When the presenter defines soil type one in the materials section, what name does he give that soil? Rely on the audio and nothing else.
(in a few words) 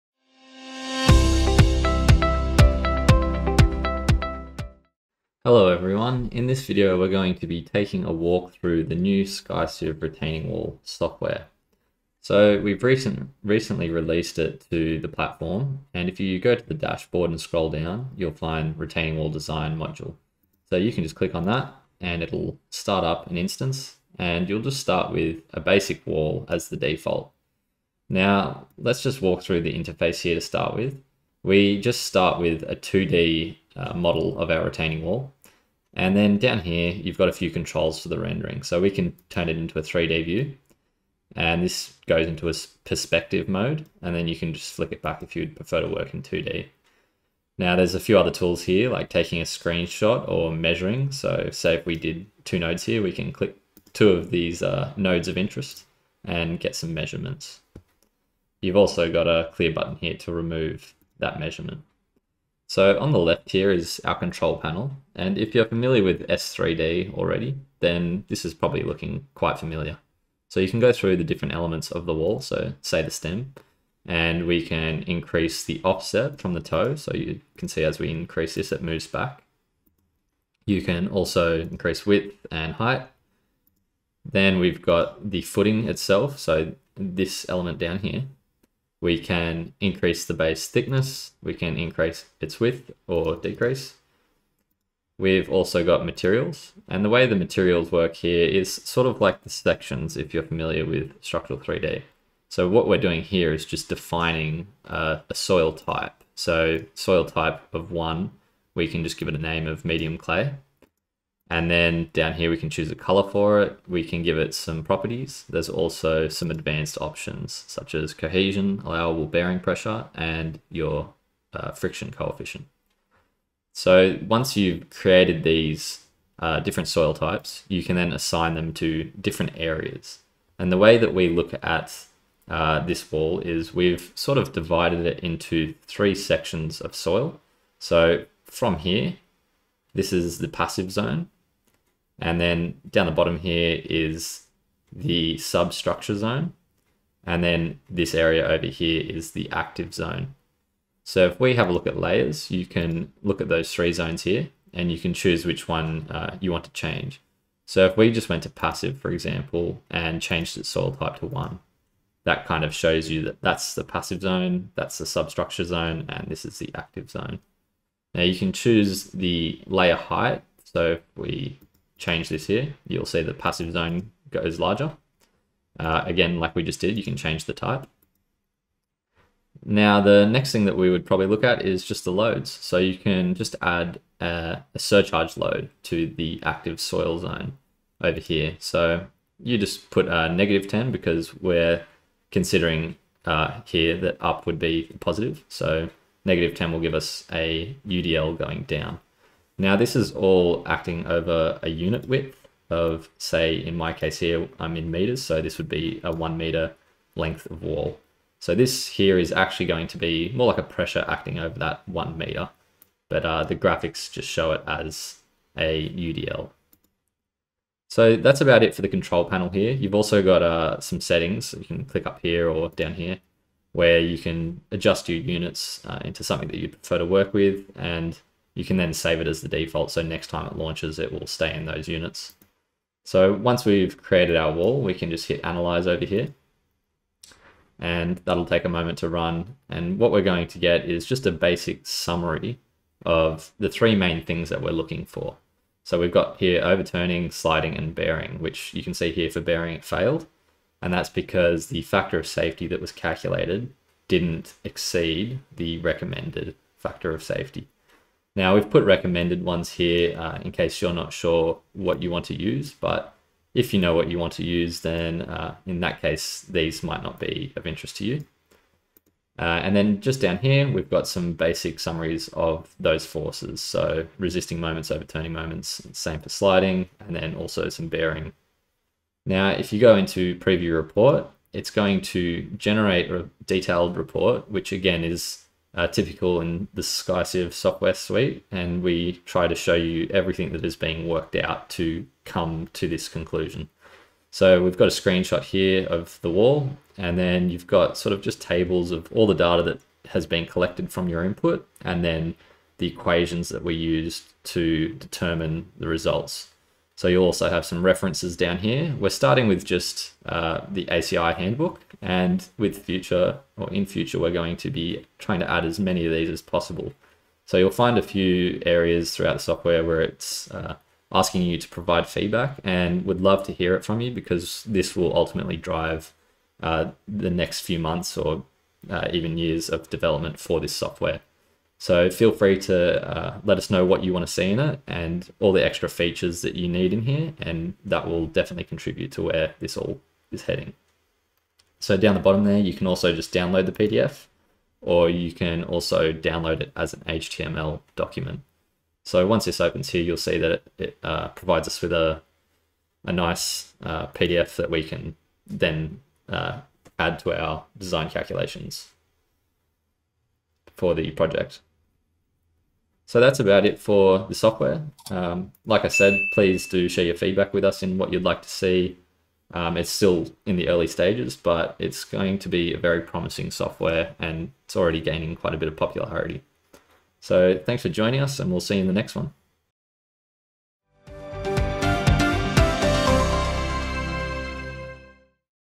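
medium clay.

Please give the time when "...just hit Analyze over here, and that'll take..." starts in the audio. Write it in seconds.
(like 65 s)
235 s.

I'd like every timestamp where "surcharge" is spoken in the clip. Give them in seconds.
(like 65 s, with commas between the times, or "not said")
184 s.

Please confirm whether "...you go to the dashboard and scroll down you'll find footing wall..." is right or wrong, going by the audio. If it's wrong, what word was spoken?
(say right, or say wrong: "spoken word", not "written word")
wrong: "retaining", not "footing".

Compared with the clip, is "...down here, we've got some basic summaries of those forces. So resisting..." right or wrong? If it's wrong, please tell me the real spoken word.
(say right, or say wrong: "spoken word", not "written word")
right.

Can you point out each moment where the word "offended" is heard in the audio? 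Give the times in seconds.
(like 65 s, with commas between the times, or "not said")
not said.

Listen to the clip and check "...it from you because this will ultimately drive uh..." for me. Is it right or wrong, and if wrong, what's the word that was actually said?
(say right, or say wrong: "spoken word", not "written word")
right.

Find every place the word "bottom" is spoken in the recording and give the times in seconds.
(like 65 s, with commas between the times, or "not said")
143 s, 342 s.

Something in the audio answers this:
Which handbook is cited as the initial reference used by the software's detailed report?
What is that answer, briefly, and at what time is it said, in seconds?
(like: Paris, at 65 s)
ACI handbook, at 310 s.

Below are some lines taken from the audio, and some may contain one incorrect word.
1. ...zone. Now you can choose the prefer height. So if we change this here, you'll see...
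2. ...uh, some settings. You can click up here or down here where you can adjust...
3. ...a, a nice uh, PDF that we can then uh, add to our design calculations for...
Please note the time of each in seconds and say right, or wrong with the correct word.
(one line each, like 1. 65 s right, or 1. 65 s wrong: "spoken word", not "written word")
1. 167 s wrong: "layer", not "prefer"
2. 220 s right
3. 351 s right.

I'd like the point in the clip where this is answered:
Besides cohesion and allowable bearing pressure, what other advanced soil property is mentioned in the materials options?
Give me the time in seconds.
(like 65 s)
121 s.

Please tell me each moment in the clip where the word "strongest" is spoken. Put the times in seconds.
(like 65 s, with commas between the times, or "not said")
not said.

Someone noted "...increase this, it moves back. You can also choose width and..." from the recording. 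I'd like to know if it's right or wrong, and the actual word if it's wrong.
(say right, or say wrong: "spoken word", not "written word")
wrong: "increase", not "choose".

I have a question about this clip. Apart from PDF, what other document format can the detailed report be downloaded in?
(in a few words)
HTML.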